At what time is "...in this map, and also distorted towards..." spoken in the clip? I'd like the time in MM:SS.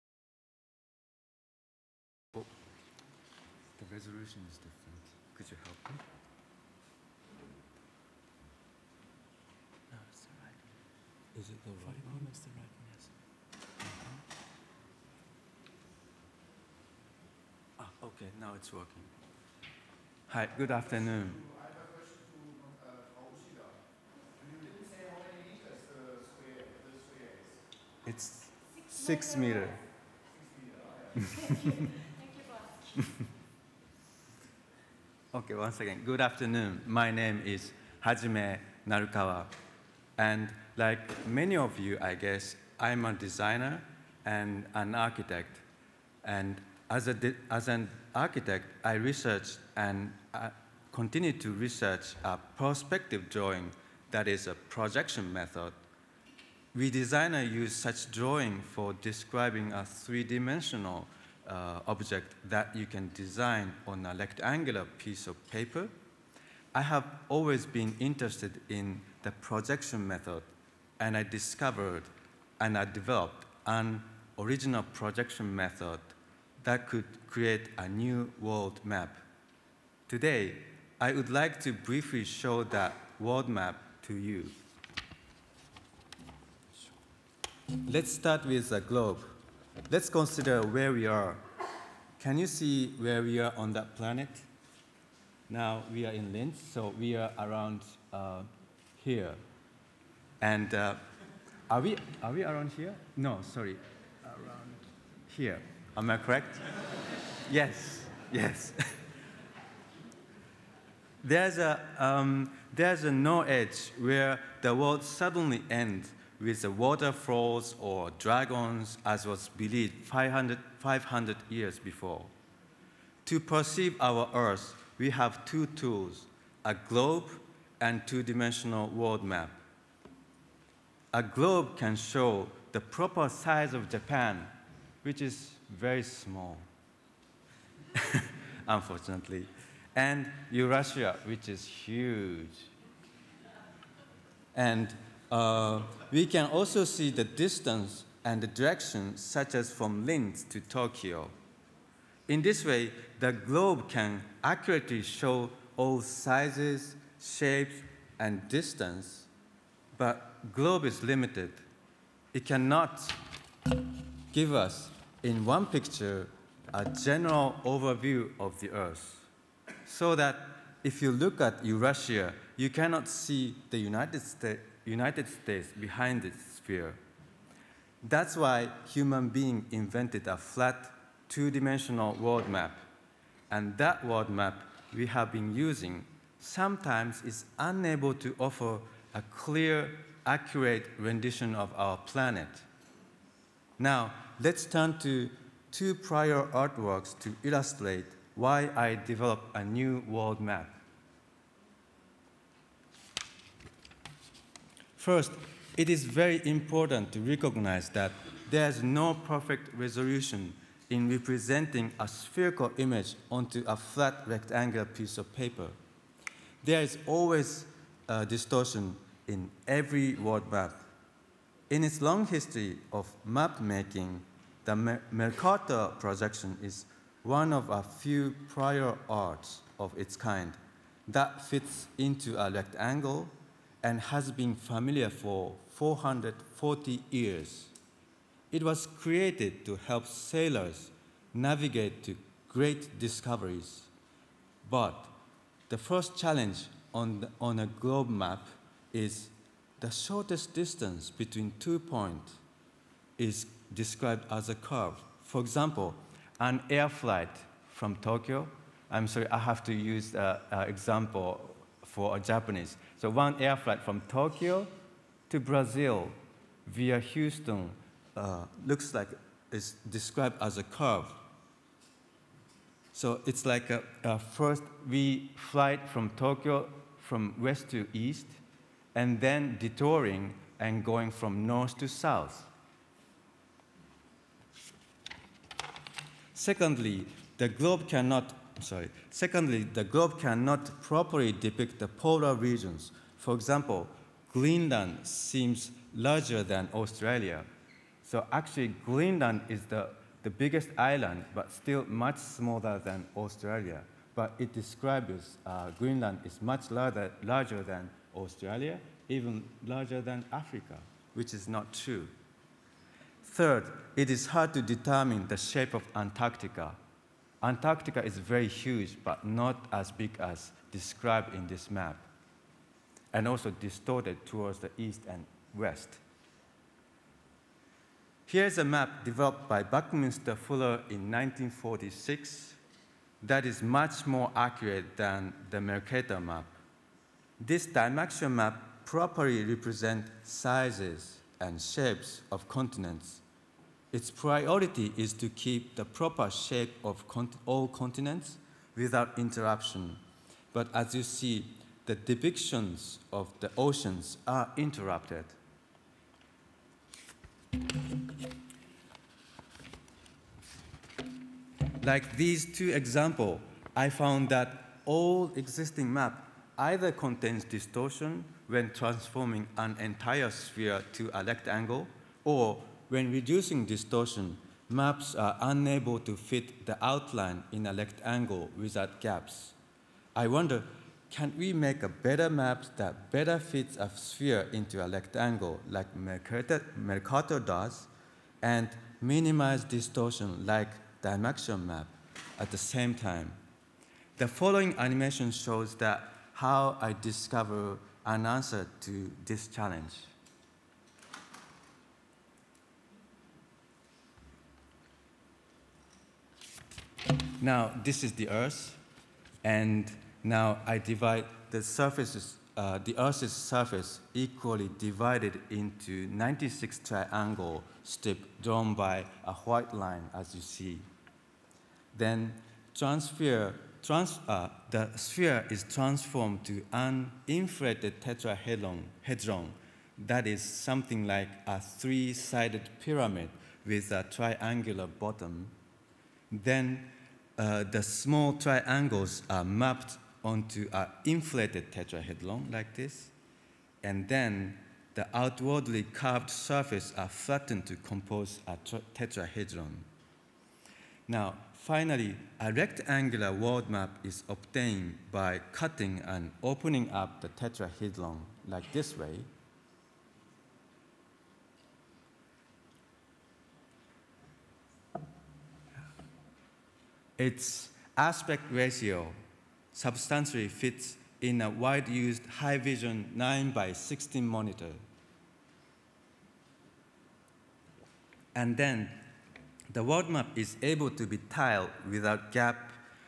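05:21.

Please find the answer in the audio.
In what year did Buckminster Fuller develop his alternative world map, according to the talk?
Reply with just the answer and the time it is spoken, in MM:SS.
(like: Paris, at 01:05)
1946, at 05:31.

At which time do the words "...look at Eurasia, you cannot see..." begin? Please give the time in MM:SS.
02:51.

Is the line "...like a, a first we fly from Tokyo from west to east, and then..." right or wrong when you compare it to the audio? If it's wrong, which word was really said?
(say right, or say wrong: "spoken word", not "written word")
right.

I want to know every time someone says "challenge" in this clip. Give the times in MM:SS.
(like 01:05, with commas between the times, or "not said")
04:06, 06:39.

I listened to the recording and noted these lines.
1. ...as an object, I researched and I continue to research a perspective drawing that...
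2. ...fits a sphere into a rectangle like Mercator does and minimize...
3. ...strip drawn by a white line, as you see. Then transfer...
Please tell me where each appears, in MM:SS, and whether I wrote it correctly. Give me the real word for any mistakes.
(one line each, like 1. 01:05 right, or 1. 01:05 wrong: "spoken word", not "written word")
1. 00:47 wrong: "architect", not "object"
2. 06:23 right
3. 06:57 right.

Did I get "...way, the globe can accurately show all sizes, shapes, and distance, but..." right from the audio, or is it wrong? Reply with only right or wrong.
right.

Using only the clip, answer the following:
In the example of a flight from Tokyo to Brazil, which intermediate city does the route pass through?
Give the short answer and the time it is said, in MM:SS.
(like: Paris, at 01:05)
Houston, at 04:26.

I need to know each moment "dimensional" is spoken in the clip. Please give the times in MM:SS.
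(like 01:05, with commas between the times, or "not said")
00:59, 02:08, 03:01.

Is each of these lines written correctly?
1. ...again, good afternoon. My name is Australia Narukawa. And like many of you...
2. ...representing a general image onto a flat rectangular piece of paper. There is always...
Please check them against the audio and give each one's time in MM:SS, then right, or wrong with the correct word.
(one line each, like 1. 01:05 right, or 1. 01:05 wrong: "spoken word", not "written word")
1. 00:35 wrong: "Hajime", not "Australia"
2. 03:31 wrong: "spherical", not "general".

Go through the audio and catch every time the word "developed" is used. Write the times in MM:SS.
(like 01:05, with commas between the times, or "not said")
01:12, 03:19, 05:29.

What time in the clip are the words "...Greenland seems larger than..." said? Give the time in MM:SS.
04:54.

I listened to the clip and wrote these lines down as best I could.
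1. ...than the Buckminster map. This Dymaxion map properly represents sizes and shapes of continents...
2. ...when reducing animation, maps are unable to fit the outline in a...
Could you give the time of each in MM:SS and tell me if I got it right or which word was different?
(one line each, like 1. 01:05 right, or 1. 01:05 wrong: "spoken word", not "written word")
1. 05:34 wrong: "Mercator", not "Buckminster"
2. 06:12 wrong: "distortion", not "animation".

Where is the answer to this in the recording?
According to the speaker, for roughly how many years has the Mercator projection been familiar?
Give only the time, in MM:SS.
03:55.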